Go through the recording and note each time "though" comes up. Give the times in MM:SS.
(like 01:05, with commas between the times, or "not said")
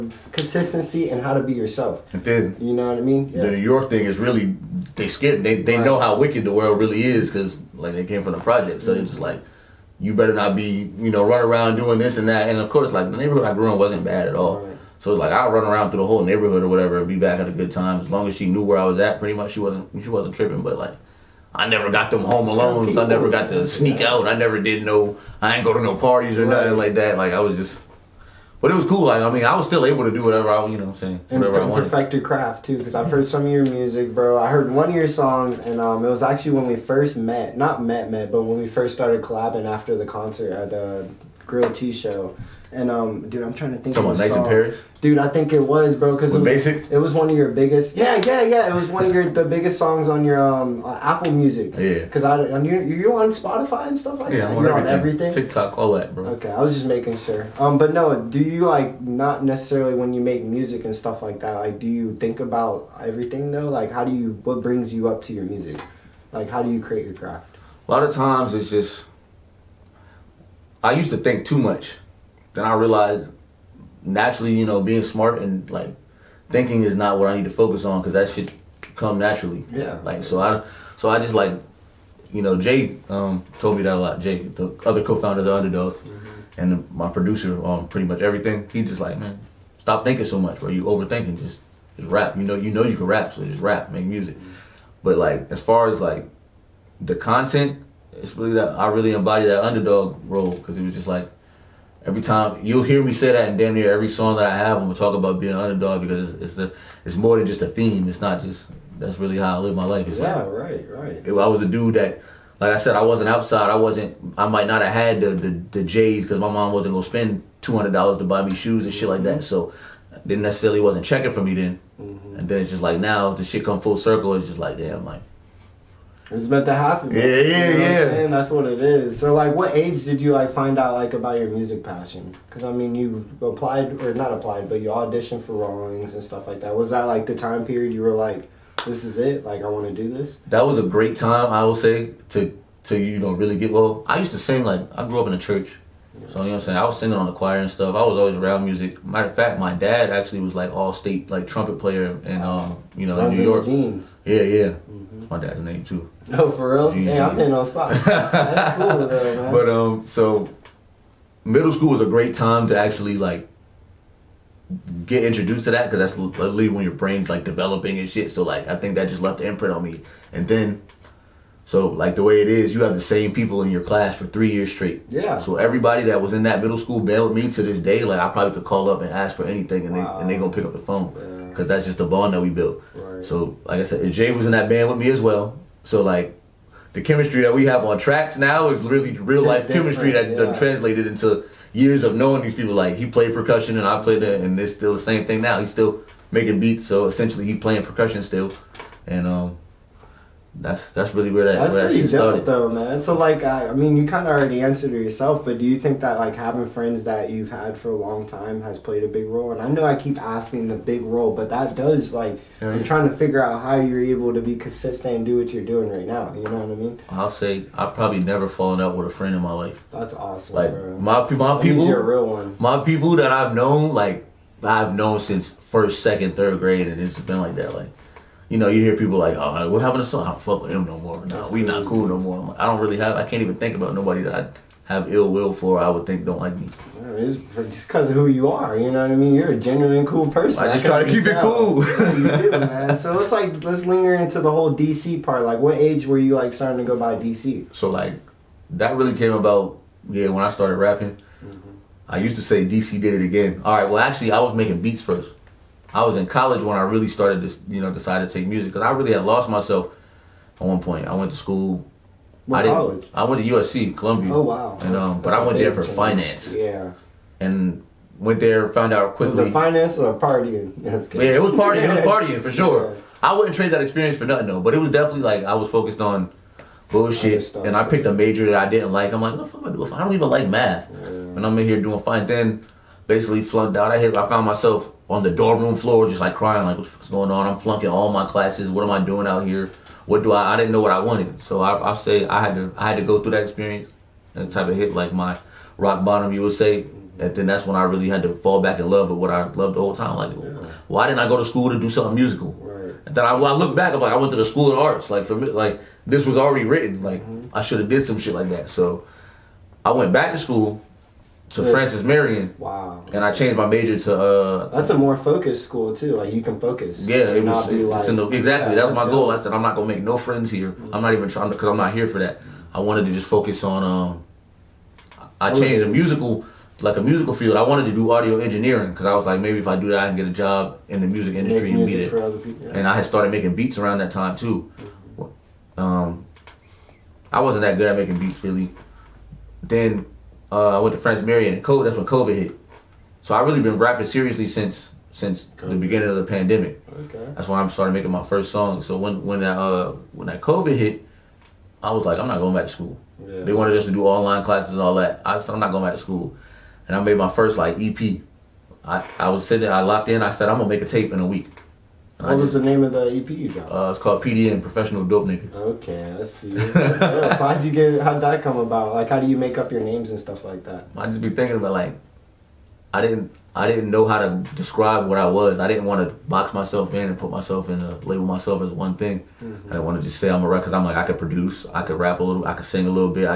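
01:03, 02:39, 03:22, 04:34.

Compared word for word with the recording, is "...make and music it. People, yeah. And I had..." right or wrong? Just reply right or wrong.
right.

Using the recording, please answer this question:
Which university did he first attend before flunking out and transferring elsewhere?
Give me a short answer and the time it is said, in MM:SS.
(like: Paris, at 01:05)
USC Columbia, at 04:23.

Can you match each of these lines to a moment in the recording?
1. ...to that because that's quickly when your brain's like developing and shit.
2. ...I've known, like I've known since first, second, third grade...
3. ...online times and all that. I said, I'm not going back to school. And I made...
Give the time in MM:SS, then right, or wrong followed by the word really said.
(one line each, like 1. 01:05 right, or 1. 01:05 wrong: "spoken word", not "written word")
1. 02:45 wrong: "literally", not "quickly"
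2. 03:43 right
3. 05:54 wrong: "classes", not "times".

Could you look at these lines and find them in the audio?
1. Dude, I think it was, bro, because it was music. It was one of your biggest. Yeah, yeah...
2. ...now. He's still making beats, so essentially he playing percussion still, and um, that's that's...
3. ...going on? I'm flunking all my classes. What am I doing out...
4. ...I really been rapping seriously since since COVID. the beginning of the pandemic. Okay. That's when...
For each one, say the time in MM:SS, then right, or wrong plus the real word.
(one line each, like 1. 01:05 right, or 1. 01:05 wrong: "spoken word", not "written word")
1. 00:45 wrong: "basic", not "music"
2. 03:15 right
3. 04:47 right
4. 05:43 right.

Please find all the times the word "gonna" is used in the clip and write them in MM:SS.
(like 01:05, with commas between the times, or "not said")
01:44, 01:56, 03:00, 06:00.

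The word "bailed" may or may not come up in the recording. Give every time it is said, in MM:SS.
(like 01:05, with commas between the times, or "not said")
02:56.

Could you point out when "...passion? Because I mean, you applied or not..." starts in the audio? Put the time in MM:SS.
02:11.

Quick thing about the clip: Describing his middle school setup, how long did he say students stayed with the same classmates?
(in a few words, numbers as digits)
3 years.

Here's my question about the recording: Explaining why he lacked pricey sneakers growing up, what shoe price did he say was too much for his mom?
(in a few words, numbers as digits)
$200.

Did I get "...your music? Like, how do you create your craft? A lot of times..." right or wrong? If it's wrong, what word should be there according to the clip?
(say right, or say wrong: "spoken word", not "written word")
right.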